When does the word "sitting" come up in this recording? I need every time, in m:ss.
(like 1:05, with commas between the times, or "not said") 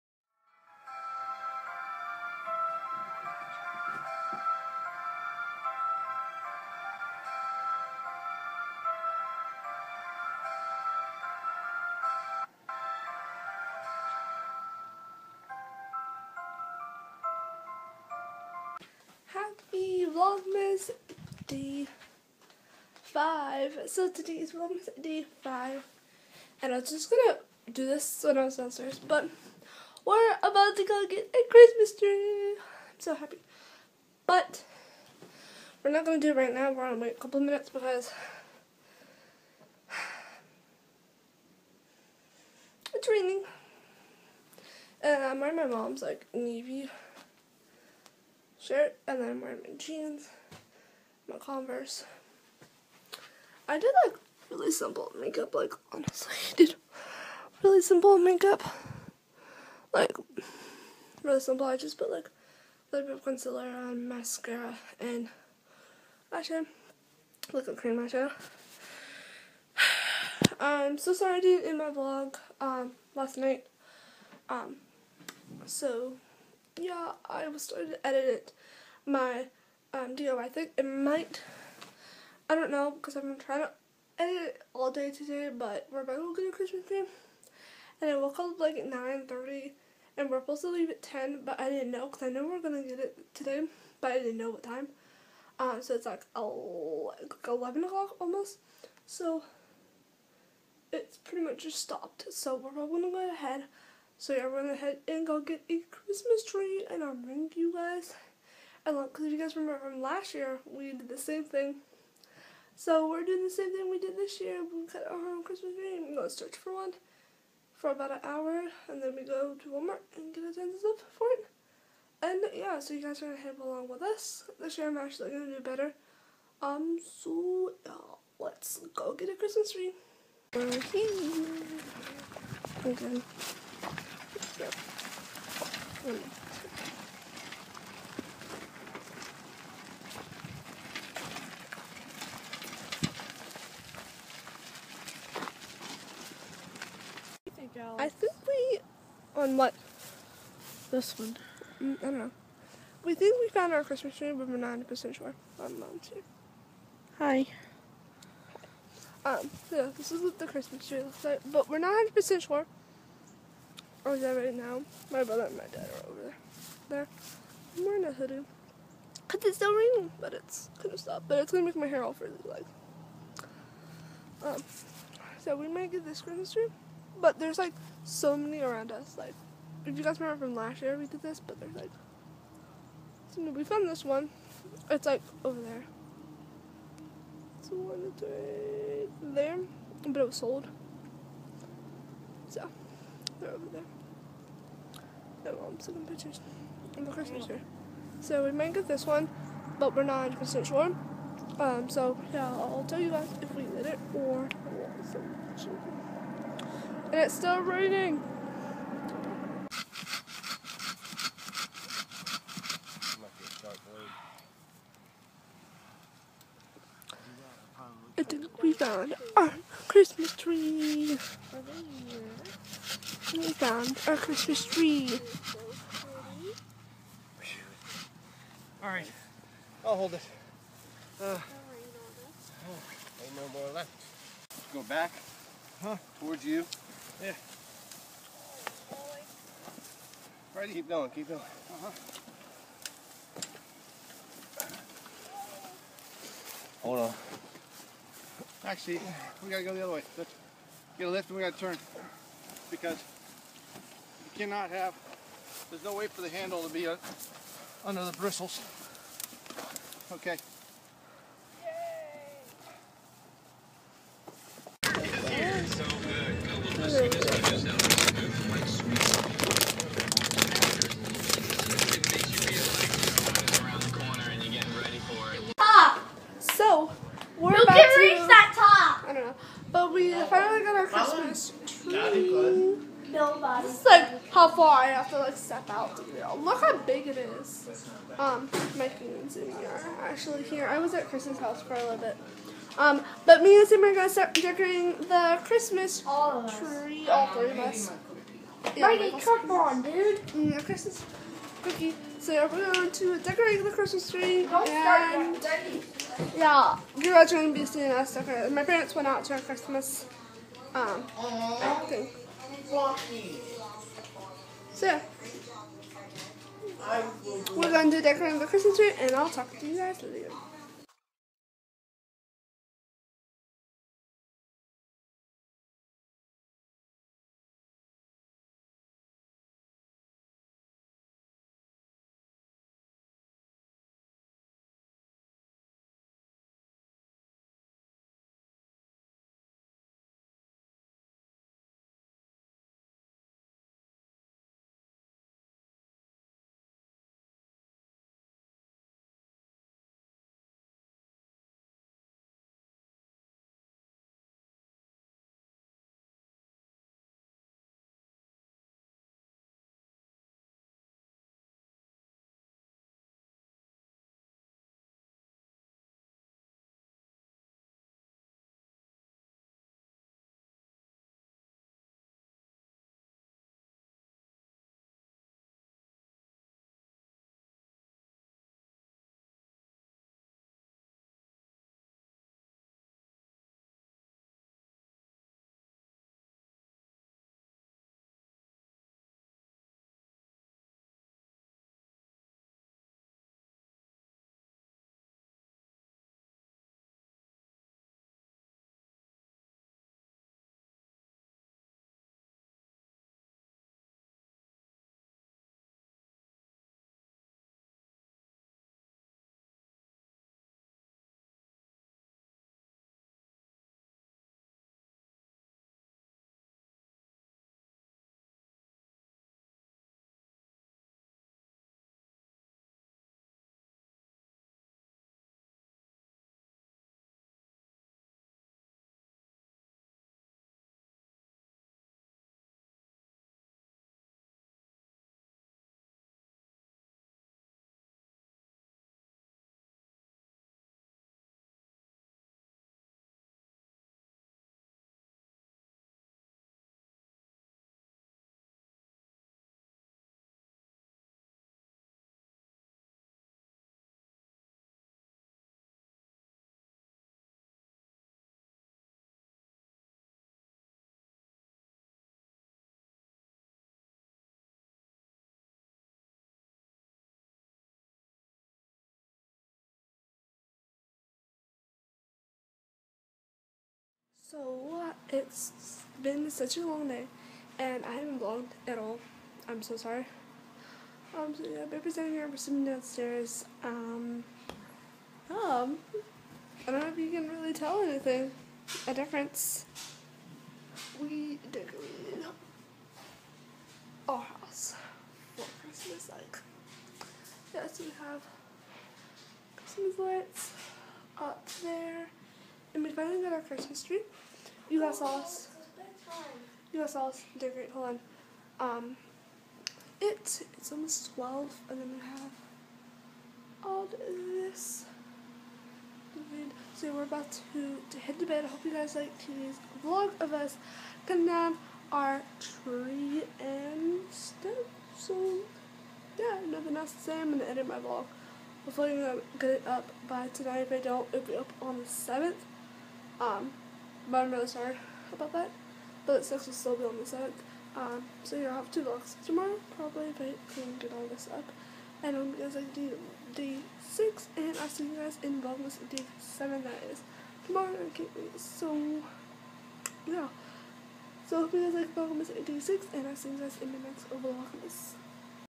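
8:02.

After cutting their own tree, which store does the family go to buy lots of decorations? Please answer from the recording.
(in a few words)
Walmart.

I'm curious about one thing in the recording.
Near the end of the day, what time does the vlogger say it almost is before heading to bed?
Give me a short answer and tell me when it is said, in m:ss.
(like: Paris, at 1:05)
12, at 8:31.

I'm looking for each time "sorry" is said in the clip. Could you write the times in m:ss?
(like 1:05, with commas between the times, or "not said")
1:11, 7:59, 8:54.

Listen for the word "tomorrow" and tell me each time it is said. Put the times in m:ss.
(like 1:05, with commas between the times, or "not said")
8:59, 9:07.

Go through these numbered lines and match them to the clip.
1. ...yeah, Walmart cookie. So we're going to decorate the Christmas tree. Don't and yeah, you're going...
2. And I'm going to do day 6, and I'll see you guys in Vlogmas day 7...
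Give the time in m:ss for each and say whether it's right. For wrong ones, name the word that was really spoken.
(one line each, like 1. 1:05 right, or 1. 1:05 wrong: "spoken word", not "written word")
1. 5:00 wrong: "Christmas", not "Walmart"
2. 9:02 right.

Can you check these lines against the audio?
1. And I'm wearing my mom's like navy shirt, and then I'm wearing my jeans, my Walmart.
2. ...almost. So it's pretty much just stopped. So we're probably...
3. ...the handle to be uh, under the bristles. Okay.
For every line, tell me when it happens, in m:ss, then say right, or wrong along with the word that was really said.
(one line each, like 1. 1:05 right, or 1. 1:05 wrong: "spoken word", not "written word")
1. 0:45 wrong: "Converse", not "Walmart"
2. 1:38 right
3. 4:16 right.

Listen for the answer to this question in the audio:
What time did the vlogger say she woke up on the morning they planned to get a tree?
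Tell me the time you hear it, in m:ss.
1:28.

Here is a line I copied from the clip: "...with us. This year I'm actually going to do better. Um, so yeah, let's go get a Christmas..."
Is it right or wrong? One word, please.
right.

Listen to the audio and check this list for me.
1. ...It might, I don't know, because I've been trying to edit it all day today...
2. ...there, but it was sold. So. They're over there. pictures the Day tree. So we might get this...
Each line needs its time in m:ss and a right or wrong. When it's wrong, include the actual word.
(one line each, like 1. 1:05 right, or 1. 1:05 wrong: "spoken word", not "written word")
1. 1:20 right
2. 3:09 wrong: "Christmas", not "Day".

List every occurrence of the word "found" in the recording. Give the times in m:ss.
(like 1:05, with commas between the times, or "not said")
2:33, 3:03, 3:38, 3:43.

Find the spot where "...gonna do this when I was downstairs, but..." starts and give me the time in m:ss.
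0:27.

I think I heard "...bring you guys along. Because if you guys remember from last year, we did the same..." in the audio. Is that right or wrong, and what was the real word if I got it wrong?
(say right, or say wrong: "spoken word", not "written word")
right.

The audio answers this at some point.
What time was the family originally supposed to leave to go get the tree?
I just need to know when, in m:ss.
1:31.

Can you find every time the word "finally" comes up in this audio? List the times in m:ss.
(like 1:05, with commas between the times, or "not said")
4:40, 8:22.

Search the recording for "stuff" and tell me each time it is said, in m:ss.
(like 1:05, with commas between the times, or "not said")
2:00, 8:44.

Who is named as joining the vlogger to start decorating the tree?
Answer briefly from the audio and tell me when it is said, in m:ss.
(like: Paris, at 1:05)
Sam, at 4:53.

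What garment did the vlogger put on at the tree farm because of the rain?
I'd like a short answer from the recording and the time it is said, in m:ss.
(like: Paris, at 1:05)
A hoodie, at 2:48.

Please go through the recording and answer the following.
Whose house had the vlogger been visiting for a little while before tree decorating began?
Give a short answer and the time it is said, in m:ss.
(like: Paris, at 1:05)
Chris's, at 4:51.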